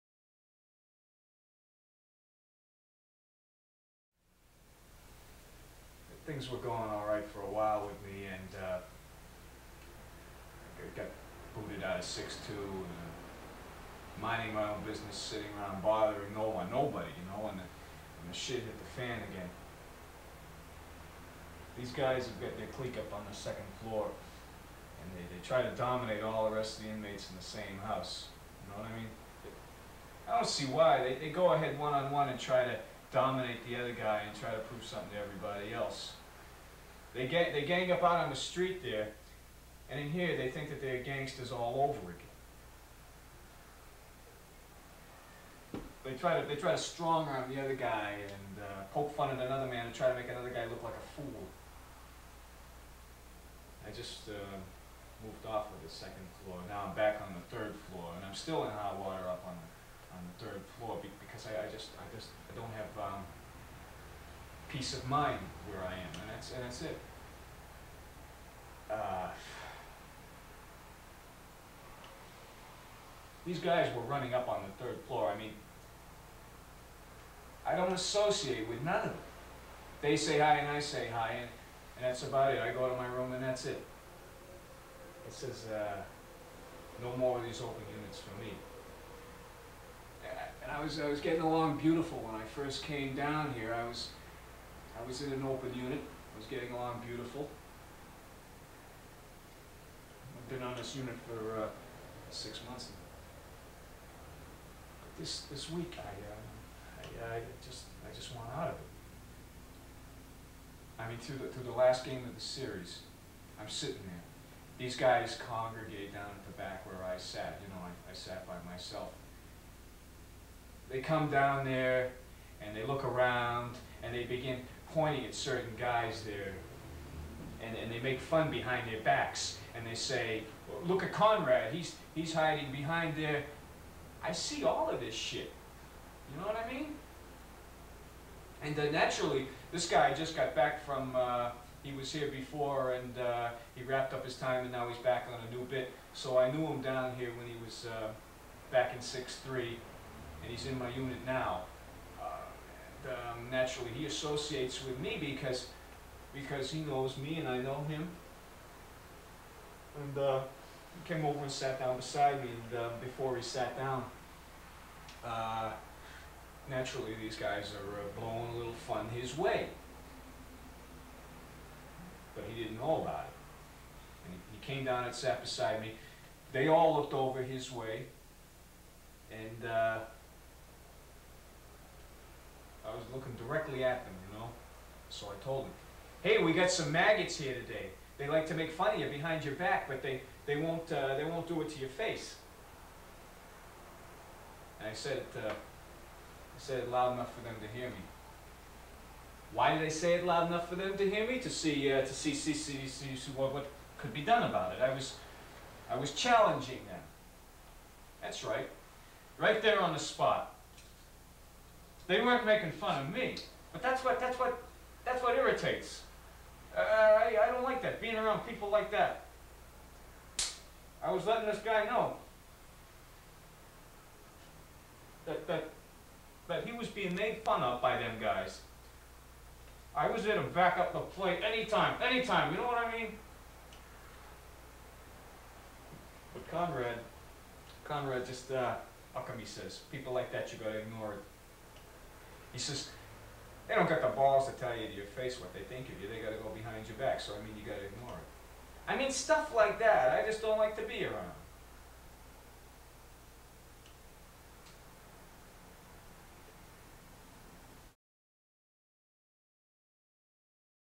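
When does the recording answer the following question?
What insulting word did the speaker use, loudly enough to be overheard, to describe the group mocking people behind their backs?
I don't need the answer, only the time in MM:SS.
03:06.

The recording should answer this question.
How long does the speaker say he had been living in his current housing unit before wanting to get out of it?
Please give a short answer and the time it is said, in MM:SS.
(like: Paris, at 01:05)
6 months, at 01:42.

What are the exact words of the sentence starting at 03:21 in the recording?
To see, uh, to see, see, see, see, see what, what could be done about it.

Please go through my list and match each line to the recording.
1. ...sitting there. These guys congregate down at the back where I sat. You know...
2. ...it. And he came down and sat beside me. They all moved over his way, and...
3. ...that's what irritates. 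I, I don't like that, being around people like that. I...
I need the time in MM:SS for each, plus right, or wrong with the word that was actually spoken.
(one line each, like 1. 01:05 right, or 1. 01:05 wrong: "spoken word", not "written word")
1. 01:53 right
2. 02:53 wrong: "looked", not "moved"
3. 03:35 right.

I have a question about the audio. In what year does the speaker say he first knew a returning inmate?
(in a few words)
63.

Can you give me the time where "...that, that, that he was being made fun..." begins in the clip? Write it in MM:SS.
03:45.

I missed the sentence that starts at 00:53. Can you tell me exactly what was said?
I just uh, moved off of the second floor.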